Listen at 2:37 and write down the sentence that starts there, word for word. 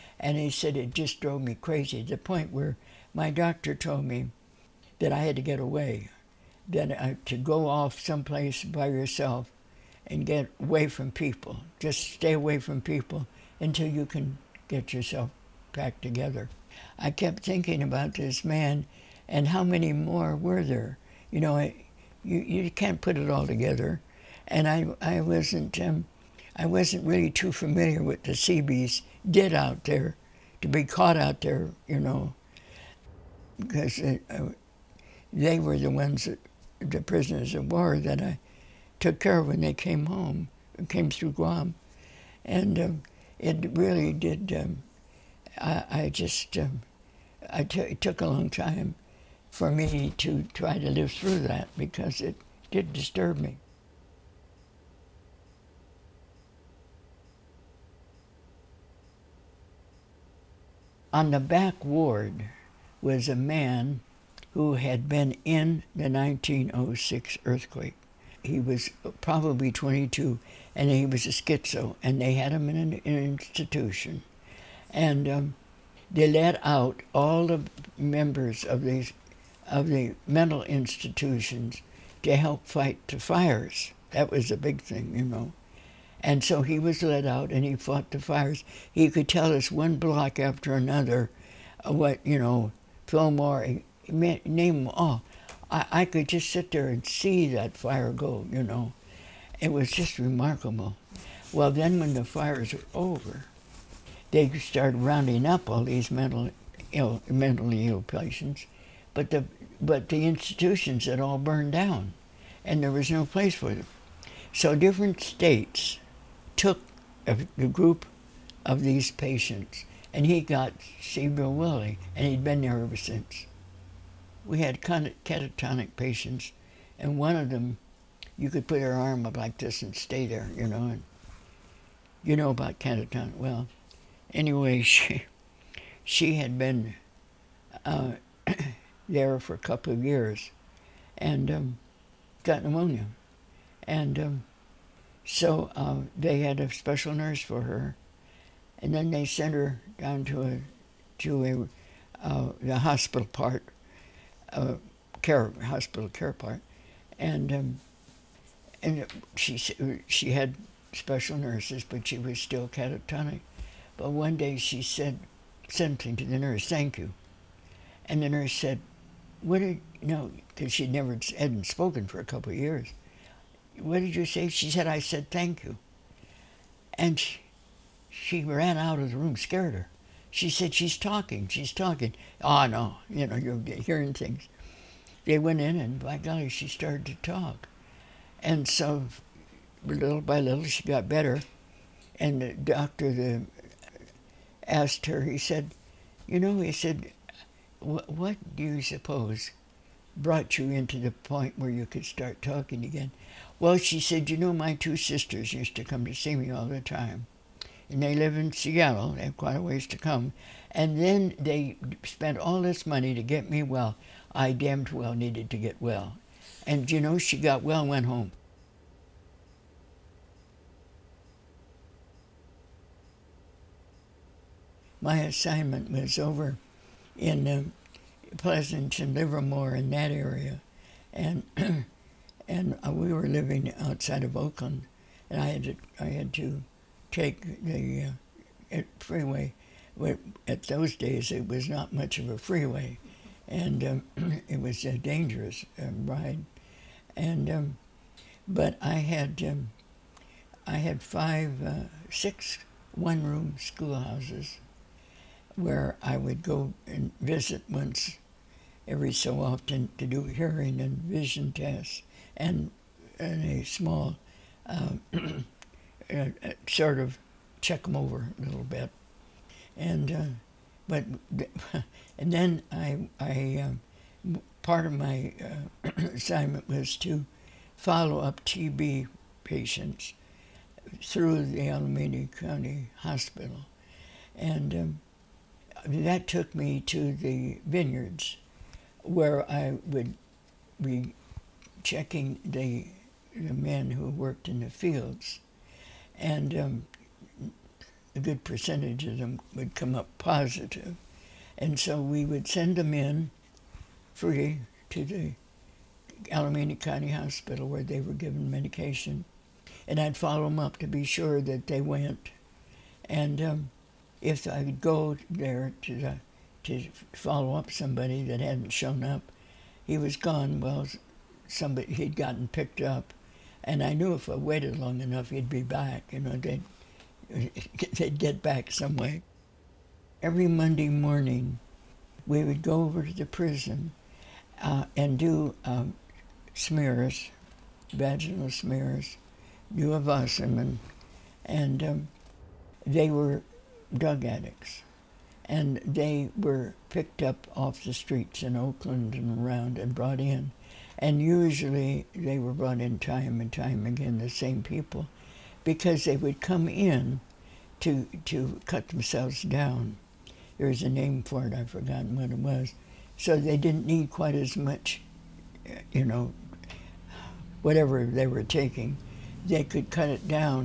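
And, um, and she, she had special nurses, but she was still catatonic.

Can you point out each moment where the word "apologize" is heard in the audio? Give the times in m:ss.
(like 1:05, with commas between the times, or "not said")
not said.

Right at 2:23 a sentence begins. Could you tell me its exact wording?
And um, so uh, they had a special nurse for her.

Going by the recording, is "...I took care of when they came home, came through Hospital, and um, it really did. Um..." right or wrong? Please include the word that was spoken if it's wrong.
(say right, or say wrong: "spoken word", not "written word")
wrong: "Guam", not "Hospital".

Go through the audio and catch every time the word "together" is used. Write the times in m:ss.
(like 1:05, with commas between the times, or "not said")
0:16, 0:23.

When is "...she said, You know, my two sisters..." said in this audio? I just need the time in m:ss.
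3:23.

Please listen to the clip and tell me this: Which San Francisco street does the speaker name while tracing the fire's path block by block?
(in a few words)
Fillmore.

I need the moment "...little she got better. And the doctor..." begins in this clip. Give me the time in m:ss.
3:10.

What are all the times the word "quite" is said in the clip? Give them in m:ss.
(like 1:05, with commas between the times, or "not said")
3:29, 6:04.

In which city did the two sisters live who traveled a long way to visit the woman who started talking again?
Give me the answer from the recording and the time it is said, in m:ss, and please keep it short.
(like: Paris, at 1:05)
Seattle, at 3:28.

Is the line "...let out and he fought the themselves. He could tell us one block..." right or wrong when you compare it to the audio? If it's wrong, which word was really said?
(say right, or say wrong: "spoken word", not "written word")
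wrong: "fires", not "themselves".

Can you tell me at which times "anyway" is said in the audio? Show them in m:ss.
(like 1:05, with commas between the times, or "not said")
2:14.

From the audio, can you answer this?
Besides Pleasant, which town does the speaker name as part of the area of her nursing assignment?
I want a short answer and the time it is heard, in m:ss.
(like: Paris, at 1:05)
Livermore, at 3:49.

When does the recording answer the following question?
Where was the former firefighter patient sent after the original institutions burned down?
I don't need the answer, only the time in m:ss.
2:01.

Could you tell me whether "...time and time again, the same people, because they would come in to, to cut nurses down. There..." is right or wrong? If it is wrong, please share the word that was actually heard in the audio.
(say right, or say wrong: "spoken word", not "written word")
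wrong: "themselves", not "nurses".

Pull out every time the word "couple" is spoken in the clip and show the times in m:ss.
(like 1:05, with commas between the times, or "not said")
2:19, 2:52.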